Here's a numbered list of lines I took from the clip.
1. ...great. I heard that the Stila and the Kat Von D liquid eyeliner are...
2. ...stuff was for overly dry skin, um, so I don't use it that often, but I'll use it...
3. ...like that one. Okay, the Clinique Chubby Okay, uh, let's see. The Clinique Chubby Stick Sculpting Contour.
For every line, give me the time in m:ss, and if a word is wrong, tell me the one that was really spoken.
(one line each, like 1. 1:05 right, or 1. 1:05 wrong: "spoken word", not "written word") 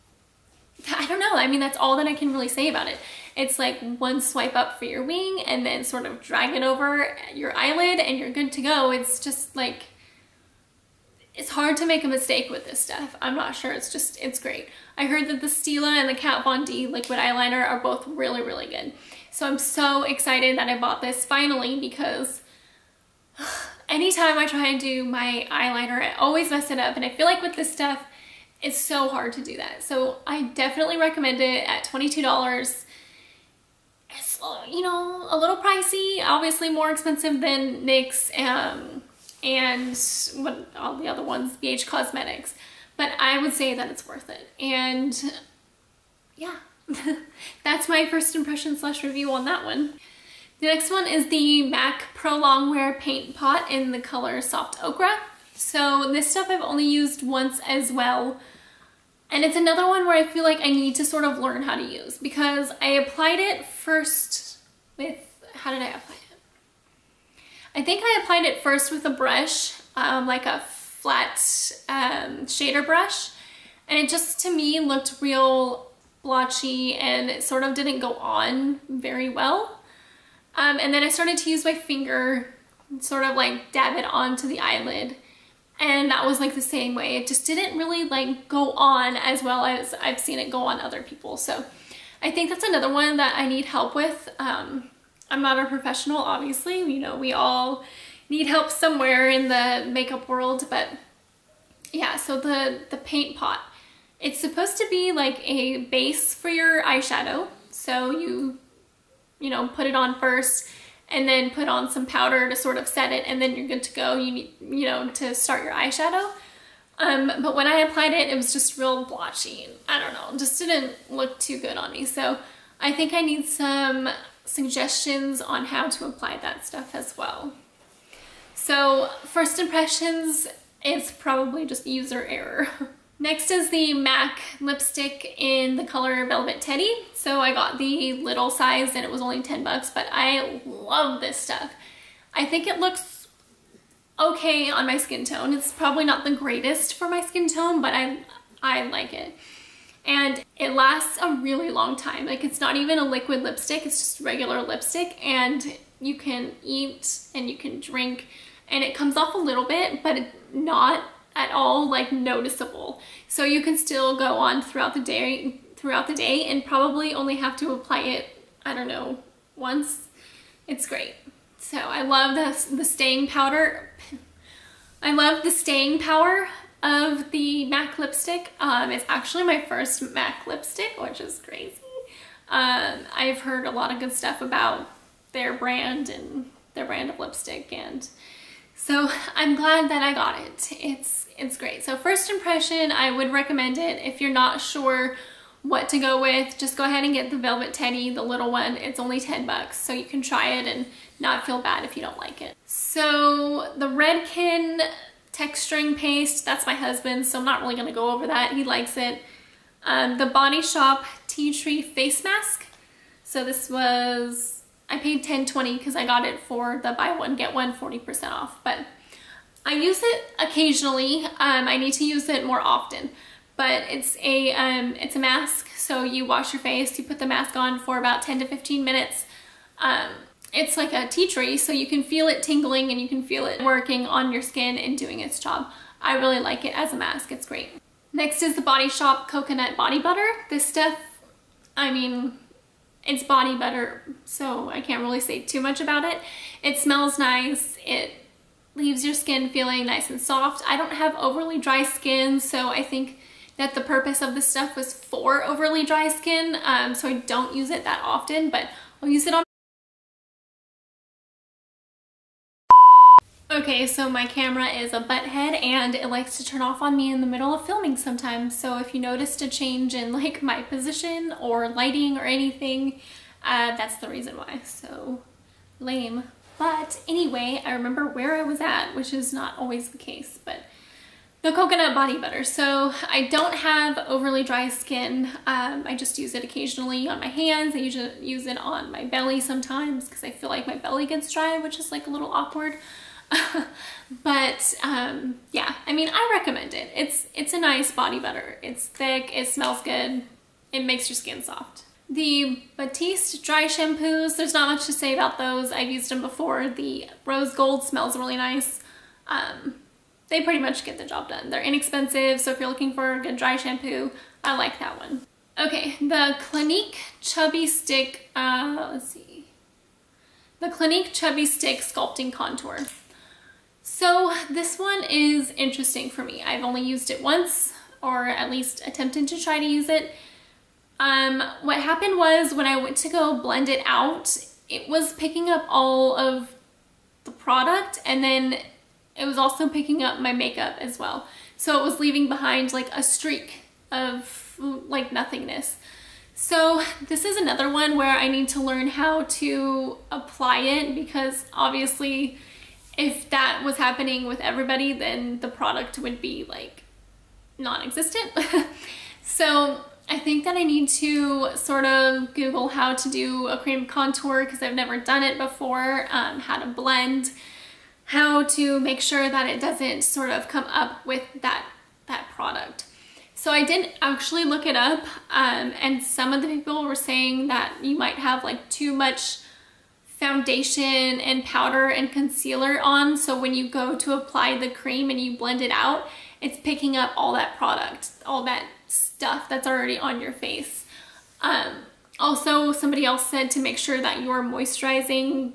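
1. 0:14 right
2. 4:14 right
3. 5:14 wrong: "Stick", not "Okay".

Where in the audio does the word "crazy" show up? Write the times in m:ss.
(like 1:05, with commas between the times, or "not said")
3:01.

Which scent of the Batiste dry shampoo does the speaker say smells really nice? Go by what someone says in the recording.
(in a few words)
rose gold.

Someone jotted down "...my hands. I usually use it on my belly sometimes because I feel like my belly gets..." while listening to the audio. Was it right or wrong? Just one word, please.
right.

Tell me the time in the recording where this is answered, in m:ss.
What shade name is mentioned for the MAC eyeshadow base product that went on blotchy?
0:54.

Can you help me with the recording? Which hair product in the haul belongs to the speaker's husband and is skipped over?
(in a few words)
Redken texturing paste.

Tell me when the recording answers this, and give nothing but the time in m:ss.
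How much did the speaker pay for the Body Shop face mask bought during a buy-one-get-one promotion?
3:35.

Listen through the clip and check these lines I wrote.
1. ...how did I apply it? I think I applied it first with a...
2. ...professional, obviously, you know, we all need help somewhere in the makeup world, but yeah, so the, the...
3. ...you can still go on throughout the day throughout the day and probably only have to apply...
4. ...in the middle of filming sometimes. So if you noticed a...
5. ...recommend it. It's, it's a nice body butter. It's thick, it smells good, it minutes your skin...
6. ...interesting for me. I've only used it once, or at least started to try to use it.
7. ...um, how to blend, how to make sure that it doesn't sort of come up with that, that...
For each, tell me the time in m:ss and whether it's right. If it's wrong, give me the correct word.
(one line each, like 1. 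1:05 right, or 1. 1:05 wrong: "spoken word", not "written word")
1. 1:05 right
2. 1:35 right
3. 2:43 right
4. 4:27 right
5. 4:56 wrong: "makes", not "minutes"
6. 5:25 wrong: "attempted", not "started"
7. 6:06 right.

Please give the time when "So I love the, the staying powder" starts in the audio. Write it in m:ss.
2:51.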